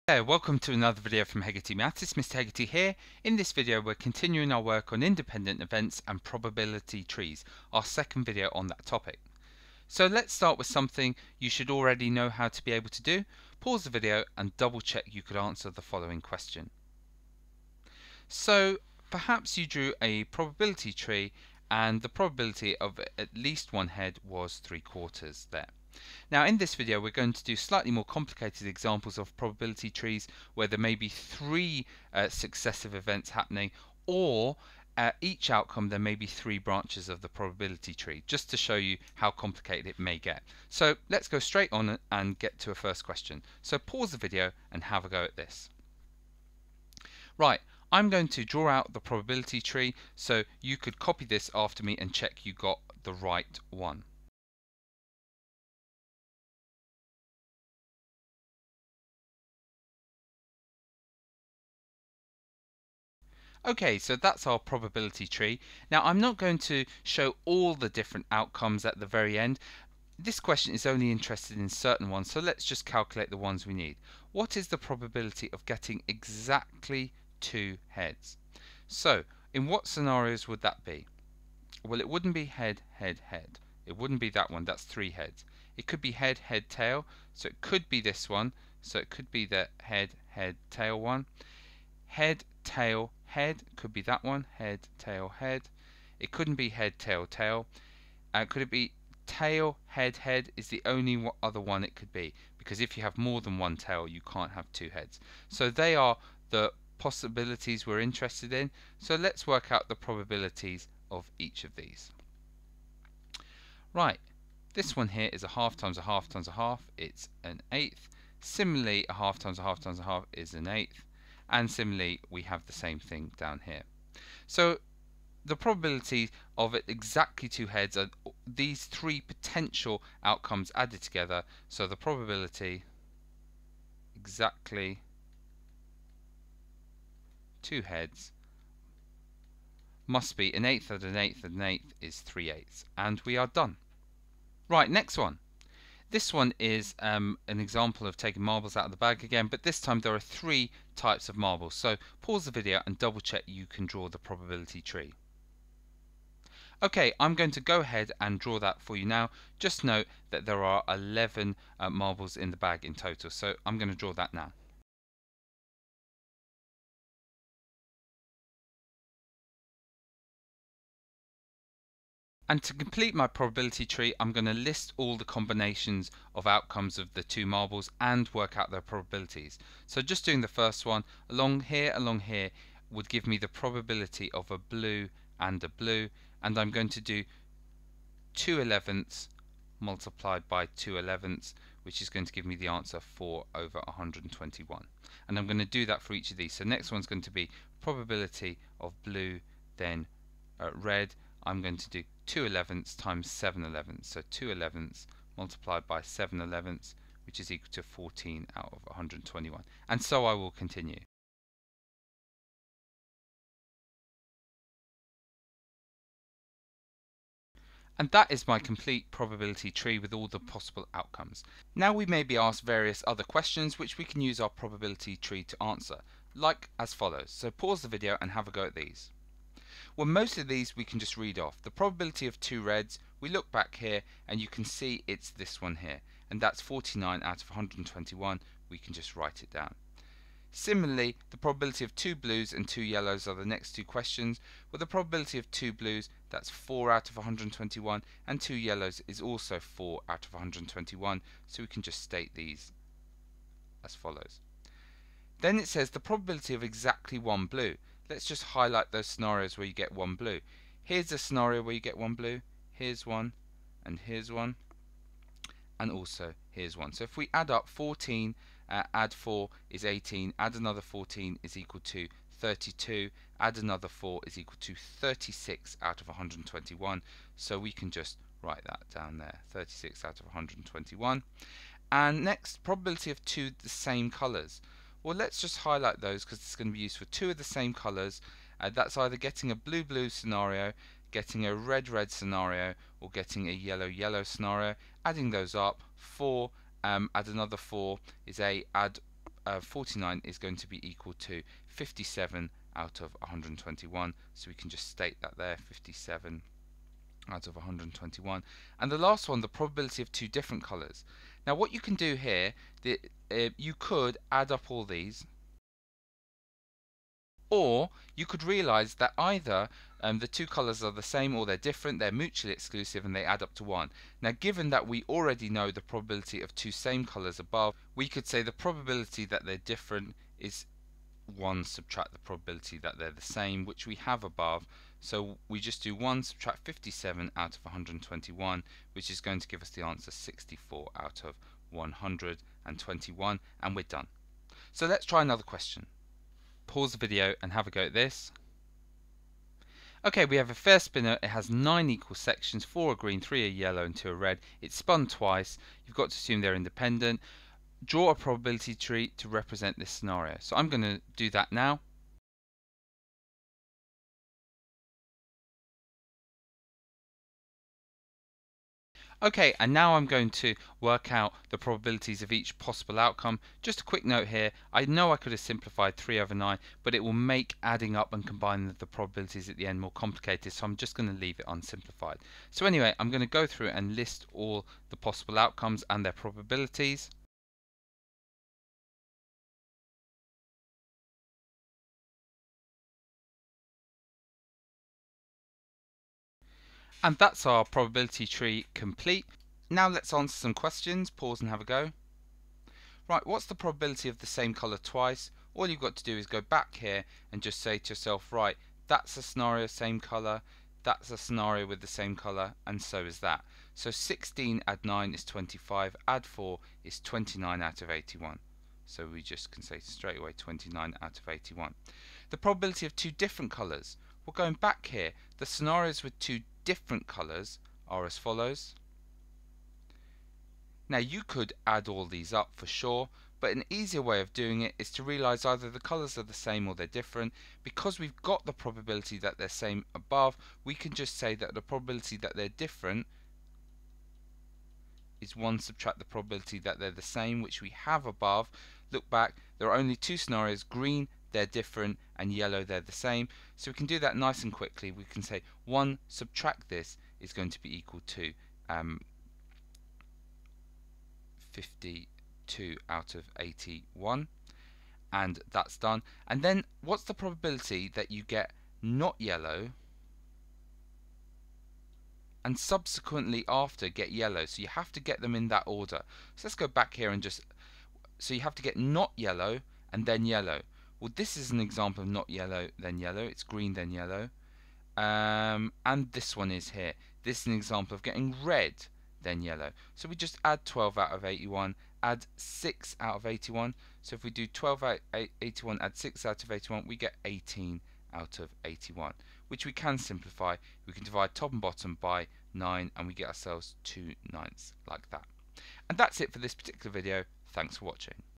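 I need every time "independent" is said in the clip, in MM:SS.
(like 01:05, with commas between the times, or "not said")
00:05, 05:56.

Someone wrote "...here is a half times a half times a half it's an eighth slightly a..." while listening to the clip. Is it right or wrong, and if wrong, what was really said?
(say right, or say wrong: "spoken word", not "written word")
wrong: "similarly", not "slightly".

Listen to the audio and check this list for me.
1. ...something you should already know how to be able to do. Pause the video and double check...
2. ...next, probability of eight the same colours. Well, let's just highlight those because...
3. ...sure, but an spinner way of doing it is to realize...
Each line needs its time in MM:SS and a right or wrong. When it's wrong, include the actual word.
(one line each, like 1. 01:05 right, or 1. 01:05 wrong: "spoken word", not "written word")
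1. 00:10 right
2. 04:42 wrong: "two", not "eight"
3. 07:12 wrong: "easier", not "spinner".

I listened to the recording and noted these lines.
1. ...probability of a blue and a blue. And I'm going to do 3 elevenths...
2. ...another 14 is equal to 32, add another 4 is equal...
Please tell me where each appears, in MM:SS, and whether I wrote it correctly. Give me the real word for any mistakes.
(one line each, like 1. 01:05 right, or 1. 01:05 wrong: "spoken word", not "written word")
1. 03:03 wrong: "2", not "3"
2. 04:30 right.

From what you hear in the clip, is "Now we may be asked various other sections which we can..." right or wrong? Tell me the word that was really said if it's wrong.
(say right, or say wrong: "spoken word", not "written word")
wrong: "questions", not "sections".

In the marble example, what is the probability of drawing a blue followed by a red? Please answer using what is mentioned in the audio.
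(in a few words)
14/121.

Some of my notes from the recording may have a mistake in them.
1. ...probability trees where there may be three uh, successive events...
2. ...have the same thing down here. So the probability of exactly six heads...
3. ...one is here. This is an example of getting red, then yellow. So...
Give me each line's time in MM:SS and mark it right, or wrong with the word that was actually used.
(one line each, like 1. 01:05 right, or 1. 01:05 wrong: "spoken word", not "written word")
1. 00:29 right
2. 02:02 wrong: "two", not "six"
3. 08:06 right.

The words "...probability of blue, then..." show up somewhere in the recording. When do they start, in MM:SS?
03:17.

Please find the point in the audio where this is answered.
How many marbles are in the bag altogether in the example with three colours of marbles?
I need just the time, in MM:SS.
02:40.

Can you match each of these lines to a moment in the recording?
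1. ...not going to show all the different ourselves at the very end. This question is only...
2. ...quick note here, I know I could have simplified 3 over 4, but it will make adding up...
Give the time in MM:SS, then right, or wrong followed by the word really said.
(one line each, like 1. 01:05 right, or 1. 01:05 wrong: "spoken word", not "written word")
1. 01:06 wrong: "outcomes", not "ourselves"
2. 06:13 wrong: "9", not "4".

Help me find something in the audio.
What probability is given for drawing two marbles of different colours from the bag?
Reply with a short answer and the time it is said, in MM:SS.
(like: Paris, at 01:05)
64/121, at 05:40.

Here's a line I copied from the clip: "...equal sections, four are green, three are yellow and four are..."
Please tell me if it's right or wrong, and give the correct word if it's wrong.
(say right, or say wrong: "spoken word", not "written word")
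wrong: "two", not "four".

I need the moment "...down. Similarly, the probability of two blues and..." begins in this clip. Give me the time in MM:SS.
03:59.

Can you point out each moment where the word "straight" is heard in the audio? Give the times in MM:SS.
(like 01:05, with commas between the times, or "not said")
00:41, 06:59.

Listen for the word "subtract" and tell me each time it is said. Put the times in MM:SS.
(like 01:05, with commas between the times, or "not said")
05:31, 05:36, 07:25, 07:36.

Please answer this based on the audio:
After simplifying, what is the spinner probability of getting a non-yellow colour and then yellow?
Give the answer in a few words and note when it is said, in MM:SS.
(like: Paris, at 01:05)
2/9, at 08:23.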